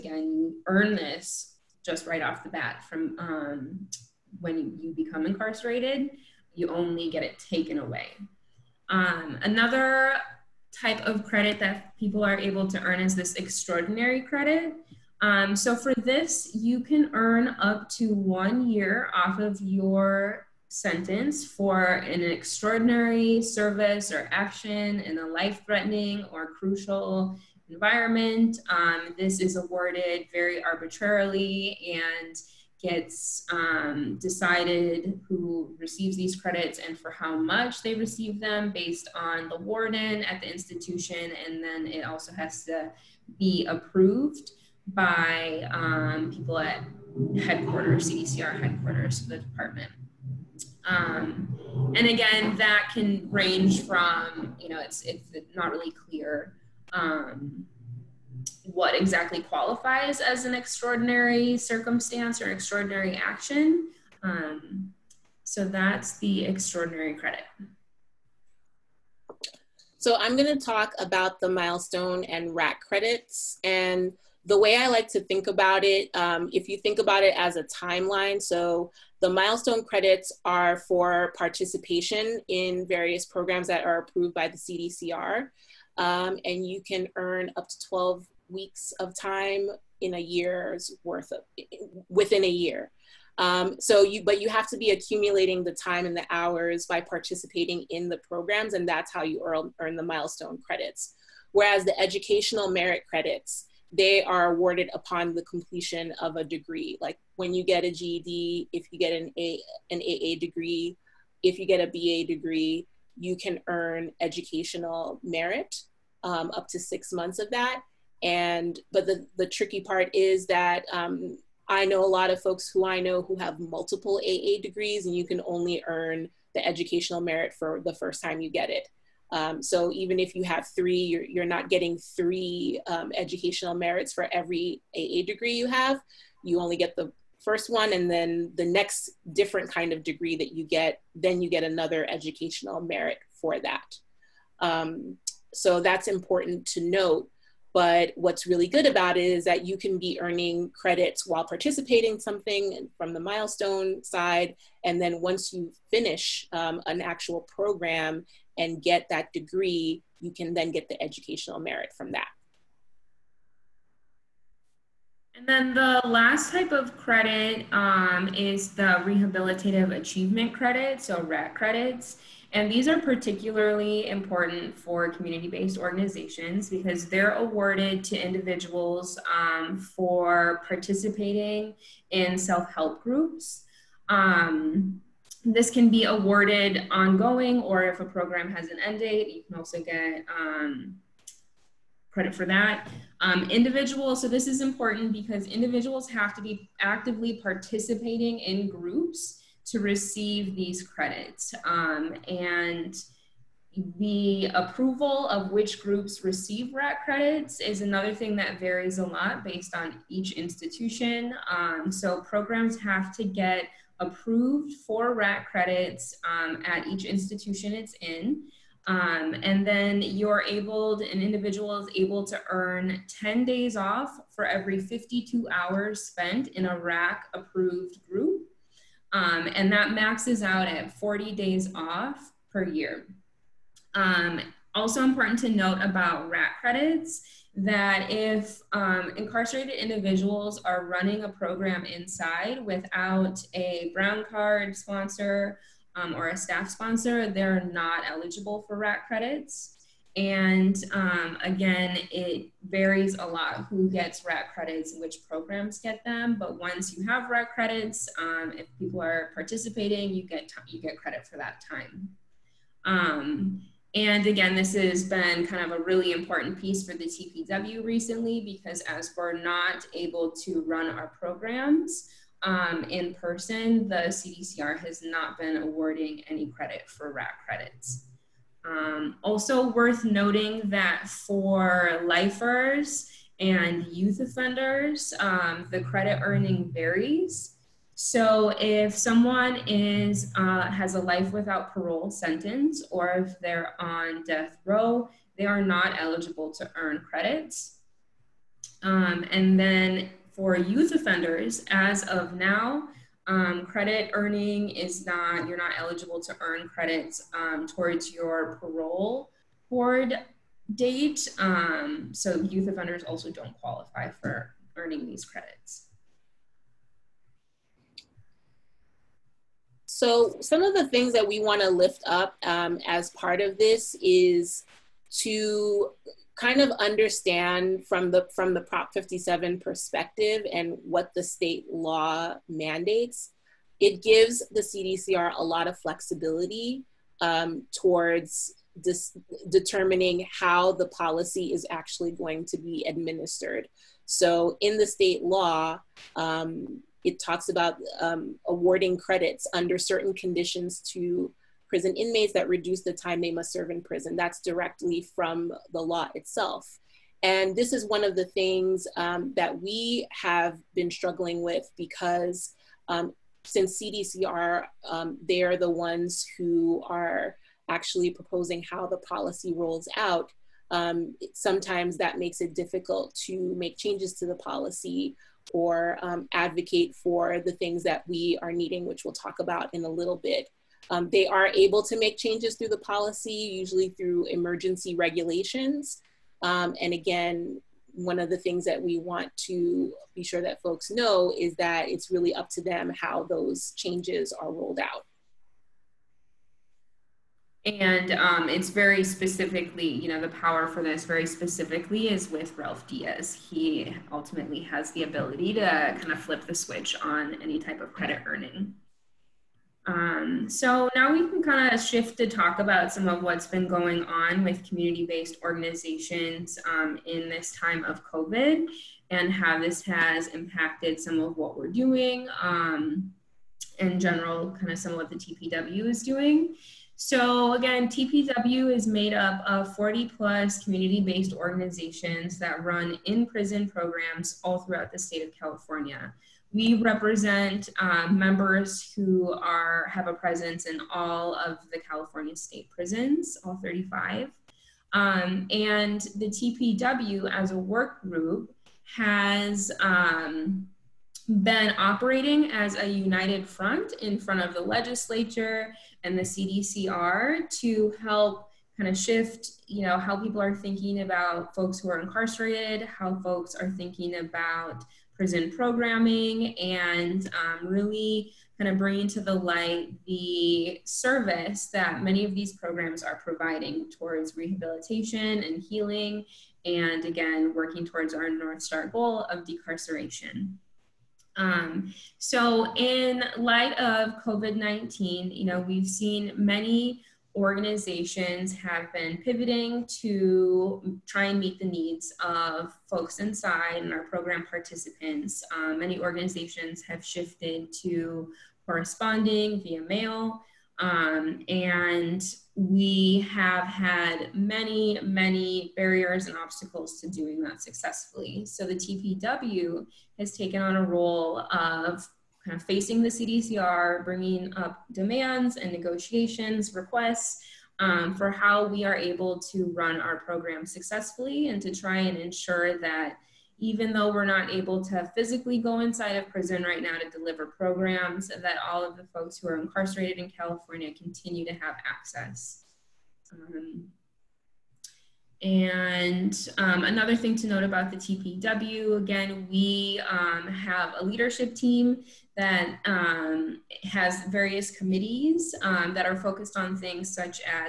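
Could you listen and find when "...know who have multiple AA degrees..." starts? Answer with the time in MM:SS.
02:03.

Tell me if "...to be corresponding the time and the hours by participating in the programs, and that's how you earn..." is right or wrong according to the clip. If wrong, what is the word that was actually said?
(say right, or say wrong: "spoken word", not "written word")
wrong: "accumulating", not "corresponding".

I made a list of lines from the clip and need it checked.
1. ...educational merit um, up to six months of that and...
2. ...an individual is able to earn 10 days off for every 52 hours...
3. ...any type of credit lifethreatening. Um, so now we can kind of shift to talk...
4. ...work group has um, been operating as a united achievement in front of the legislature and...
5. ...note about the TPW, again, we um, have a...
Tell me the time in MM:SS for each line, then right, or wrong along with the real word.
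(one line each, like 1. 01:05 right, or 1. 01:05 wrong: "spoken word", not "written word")
1. 01:54 right
2. 03:40 right
3. 06:47 wrong: "earning", not "lifethreatening"
4. 07:27 wrong: "front", not "achievement"
5. 08:57 right.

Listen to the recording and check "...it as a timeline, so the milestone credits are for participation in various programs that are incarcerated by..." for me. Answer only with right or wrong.
wrong.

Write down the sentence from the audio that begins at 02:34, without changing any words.
And then once you finish um, an actual program and get that degree, you can then get the educational merit from that.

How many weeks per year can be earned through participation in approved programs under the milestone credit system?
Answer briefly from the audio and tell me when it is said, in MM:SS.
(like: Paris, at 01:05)
12 weeks, at 01:27.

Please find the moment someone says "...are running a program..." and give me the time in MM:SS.
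04:00.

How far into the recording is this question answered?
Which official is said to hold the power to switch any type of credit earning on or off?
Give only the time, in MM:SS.
06:42.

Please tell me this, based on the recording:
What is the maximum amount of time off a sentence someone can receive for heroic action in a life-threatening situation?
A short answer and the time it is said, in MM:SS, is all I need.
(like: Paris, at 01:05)
1 year, at 00:18.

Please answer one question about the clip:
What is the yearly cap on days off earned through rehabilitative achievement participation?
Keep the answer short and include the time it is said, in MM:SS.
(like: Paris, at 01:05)
40 days, at 03:50.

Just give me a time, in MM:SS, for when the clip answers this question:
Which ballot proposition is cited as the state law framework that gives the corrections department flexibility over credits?
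05:28.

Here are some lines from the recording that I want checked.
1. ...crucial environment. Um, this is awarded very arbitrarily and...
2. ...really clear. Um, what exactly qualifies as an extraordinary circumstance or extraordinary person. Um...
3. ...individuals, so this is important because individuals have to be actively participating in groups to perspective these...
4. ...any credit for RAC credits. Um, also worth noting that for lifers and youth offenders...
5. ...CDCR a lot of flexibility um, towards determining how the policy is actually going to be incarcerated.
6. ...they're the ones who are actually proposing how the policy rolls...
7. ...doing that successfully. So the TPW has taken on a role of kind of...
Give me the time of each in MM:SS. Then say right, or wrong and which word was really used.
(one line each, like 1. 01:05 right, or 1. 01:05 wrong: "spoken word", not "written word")
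1. 00:26 right
2. 00:55 wrong: "action", not "person"
3. 03:13 wrong: "receive", not "perspective"
4. 04:36 right
5. 05:34 wrong: "administered", not "incarcerated"
6. 06:05 right
7. 08:27 right.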